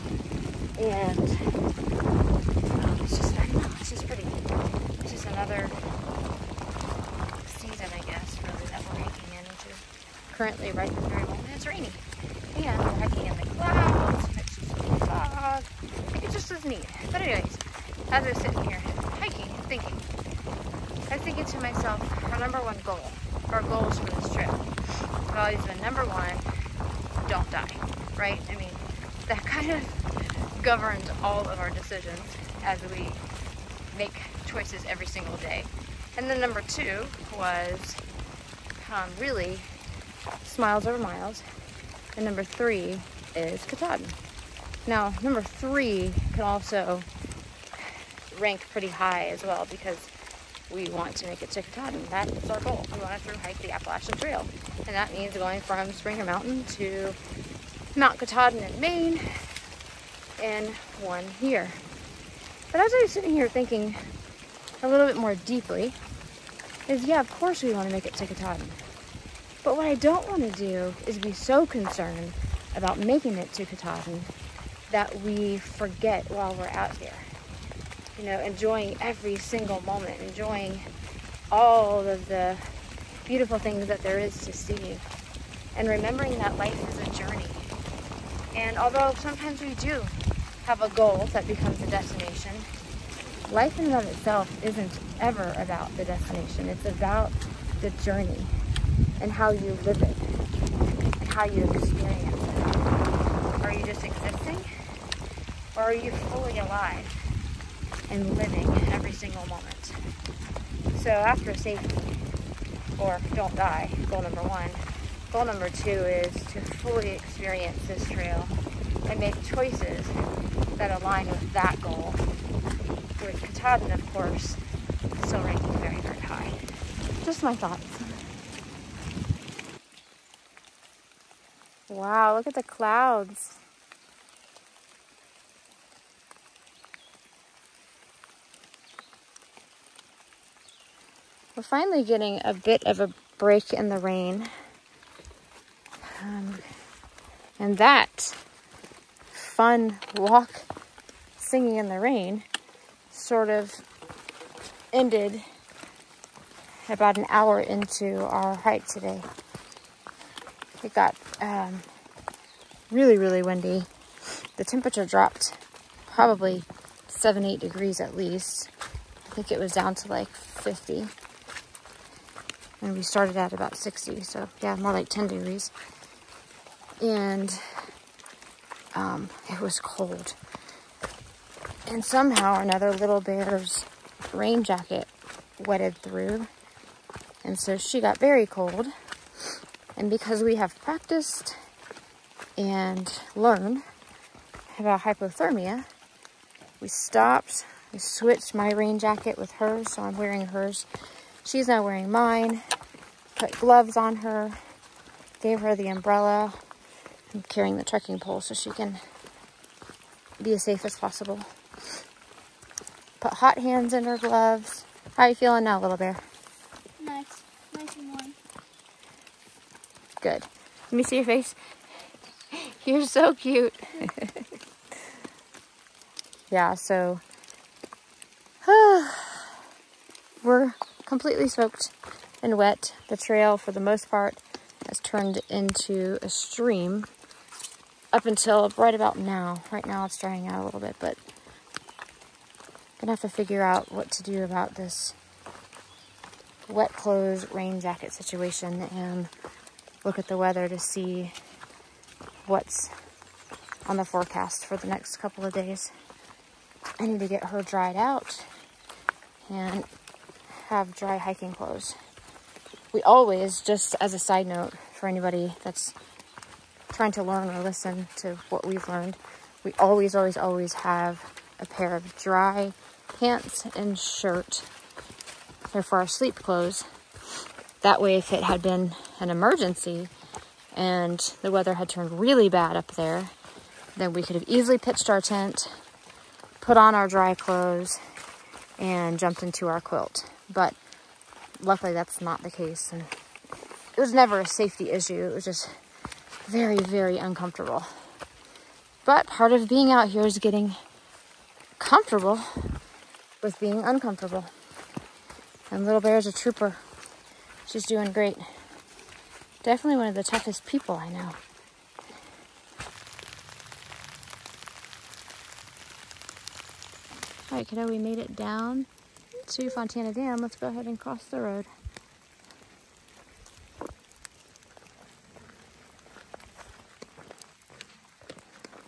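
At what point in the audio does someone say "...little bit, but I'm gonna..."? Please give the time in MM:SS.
04:00.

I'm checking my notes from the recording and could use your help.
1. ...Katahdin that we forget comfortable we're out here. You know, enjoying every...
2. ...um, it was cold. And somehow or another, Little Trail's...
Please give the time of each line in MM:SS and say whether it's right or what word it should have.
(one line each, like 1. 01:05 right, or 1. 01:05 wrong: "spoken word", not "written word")
1. 01:13 wrong: "while", not "comfortable"
2. 02:58 wrong: "Bear", not "Trail".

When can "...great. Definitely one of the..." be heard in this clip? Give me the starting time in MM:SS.
05:08.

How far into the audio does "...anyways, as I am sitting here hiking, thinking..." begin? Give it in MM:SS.
00:17.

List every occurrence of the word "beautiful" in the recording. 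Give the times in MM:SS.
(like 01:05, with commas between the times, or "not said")
01:23.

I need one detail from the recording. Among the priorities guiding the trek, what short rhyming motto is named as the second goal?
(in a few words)
Smiles over miles.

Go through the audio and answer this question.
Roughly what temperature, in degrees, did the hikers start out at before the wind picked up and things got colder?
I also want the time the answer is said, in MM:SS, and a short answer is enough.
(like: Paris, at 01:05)
60, at 02:53.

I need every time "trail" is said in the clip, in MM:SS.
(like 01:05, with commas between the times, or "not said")
00:54, 01:58, 03:53.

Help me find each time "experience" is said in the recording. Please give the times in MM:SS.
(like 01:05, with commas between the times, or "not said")
01:41, 01:57.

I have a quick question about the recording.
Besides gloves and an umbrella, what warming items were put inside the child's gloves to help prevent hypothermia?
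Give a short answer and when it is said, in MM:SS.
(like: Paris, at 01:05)
Hot hands, at 03:33.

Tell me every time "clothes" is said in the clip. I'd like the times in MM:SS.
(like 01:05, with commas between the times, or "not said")
04:06, 04:21, 04:36, 04:47.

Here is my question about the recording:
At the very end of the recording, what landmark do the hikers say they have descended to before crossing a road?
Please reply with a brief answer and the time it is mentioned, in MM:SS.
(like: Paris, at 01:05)
Fontana Dam, at 05:19.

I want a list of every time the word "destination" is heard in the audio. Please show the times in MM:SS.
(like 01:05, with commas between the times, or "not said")
01:31, 01:36.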